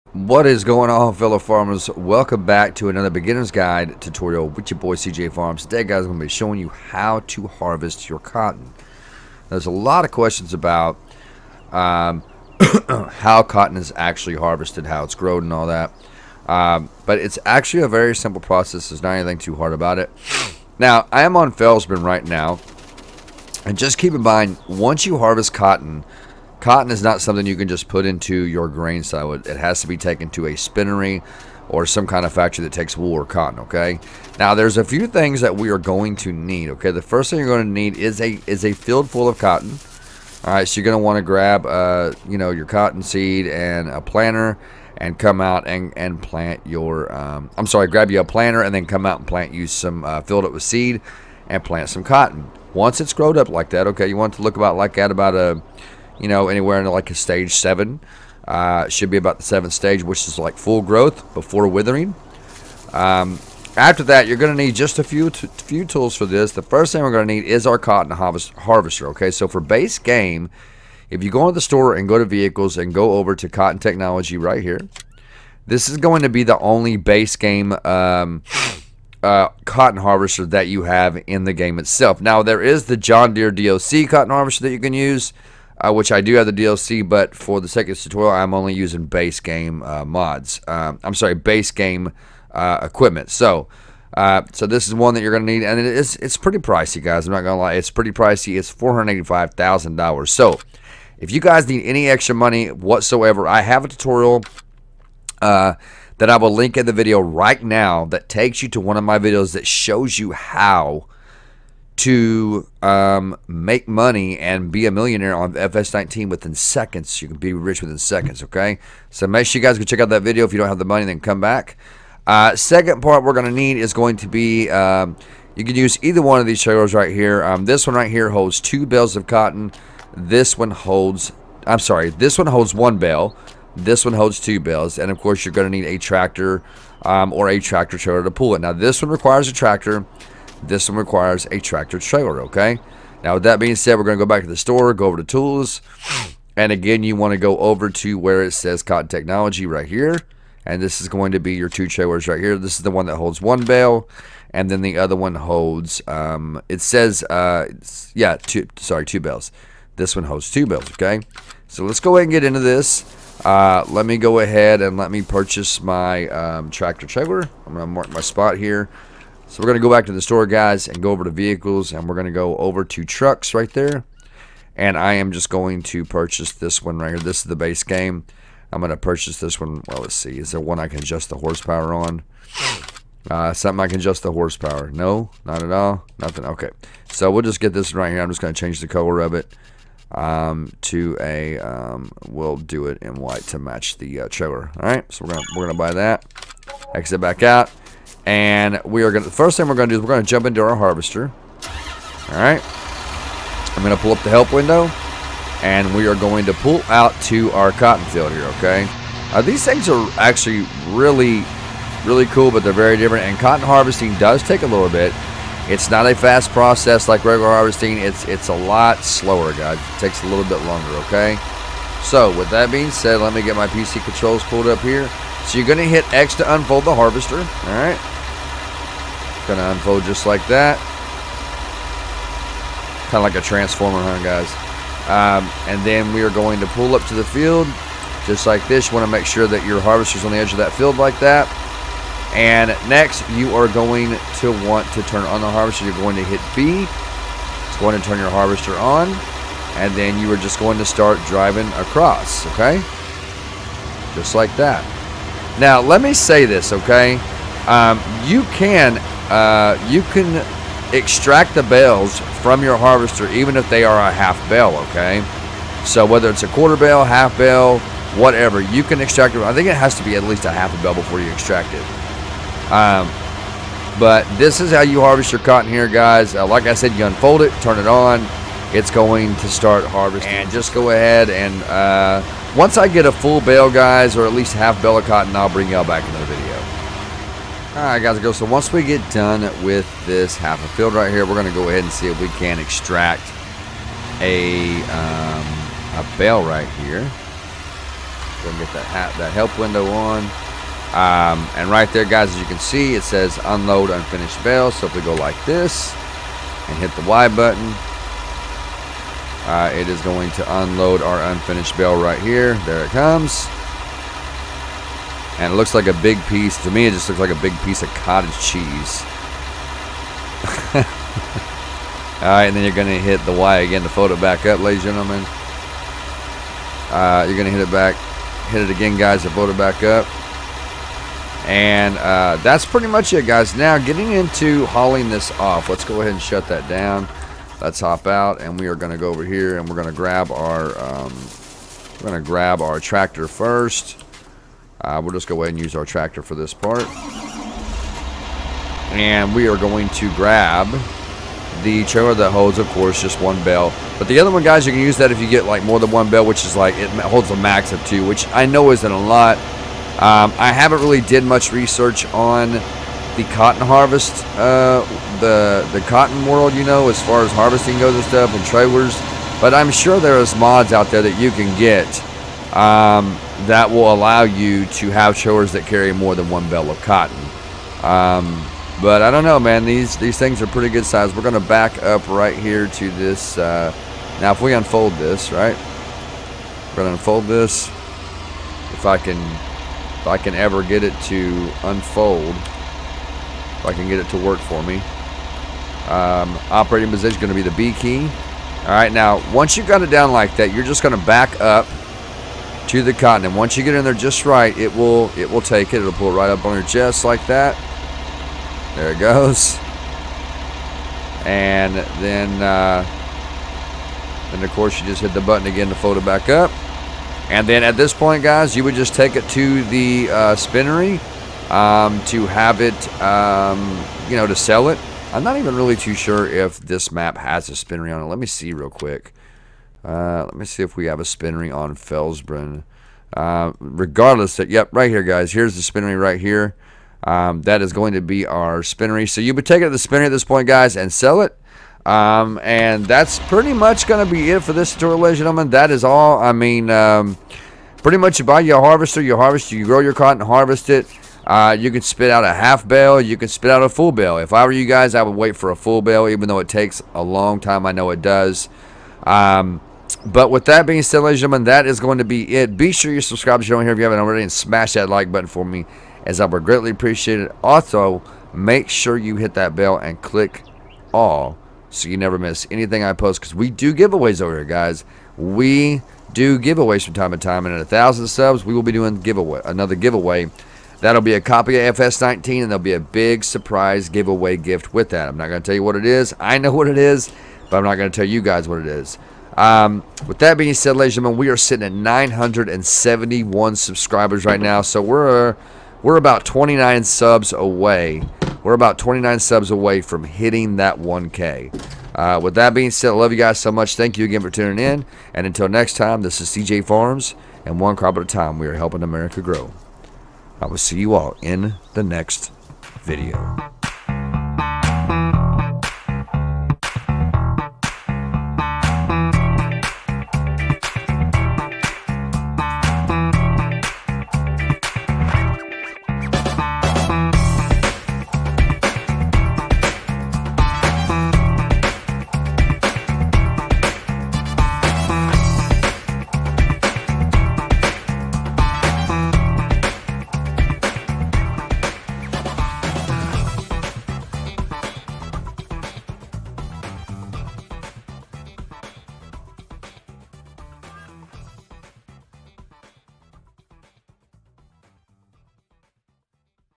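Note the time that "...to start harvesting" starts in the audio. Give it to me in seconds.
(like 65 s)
279 s.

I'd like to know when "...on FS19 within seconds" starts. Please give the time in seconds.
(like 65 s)
115 s.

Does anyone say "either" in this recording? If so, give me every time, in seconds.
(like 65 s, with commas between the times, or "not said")
126 s.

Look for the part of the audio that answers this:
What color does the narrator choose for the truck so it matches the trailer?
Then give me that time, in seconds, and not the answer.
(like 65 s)
193 s.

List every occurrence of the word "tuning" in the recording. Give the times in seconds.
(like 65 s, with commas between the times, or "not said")
504 s.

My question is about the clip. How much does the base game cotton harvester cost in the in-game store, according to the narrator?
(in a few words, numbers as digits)
$485,000.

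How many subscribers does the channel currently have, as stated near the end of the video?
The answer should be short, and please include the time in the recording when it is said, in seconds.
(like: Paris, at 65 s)
971, at 491 s.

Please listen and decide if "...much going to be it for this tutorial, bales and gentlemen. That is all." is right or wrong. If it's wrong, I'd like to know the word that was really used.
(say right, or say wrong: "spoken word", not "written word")
wrong: "ladies", not "bales".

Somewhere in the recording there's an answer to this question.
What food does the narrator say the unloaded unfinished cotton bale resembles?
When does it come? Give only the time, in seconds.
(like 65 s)
317 s.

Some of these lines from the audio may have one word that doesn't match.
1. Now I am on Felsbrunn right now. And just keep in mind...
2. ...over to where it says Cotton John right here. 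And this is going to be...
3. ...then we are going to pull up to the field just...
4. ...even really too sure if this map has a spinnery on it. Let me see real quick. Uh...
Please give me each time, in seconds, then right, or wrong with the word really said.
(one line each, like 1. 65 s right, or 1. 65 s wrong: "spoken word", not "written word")
1. 20 s right
2. 147 s wrong: "Technology", not "John"
3. 235 s right
4. 425 s right.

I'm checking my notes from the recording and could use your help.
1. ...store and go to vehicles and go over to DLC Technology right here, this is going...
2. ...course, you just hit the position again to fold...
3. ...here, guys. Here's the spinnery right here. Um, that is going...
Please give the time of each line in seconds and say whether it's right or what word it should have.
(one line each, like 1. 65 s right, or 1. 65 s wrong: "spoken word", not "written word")
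1. 71 s wrong: "Cotton", not "DLC"
2. 414 s wrong: "button", not "position"
3. 434 s right.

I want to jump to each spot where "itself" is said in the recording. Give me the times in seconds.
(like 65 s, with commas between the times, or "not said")
81 s.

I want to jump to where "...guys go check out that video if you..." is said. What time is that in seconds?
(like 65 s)
119 s.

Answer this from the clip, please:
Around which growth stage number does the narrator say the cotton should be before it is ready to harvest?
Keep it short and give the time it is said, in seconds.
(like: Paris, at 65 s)
7, at 57 s.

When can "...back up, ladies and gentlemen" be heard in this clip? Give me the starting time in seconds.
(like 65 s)
324 s.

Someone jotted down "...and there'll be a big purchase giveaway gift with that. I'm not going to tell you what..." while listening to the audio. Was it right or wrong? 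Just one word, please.
wrong.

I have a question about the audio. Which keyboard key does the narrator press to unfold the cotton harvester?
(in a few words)
X.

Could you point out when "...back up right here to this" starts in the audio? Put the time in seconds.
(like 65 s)
381 s.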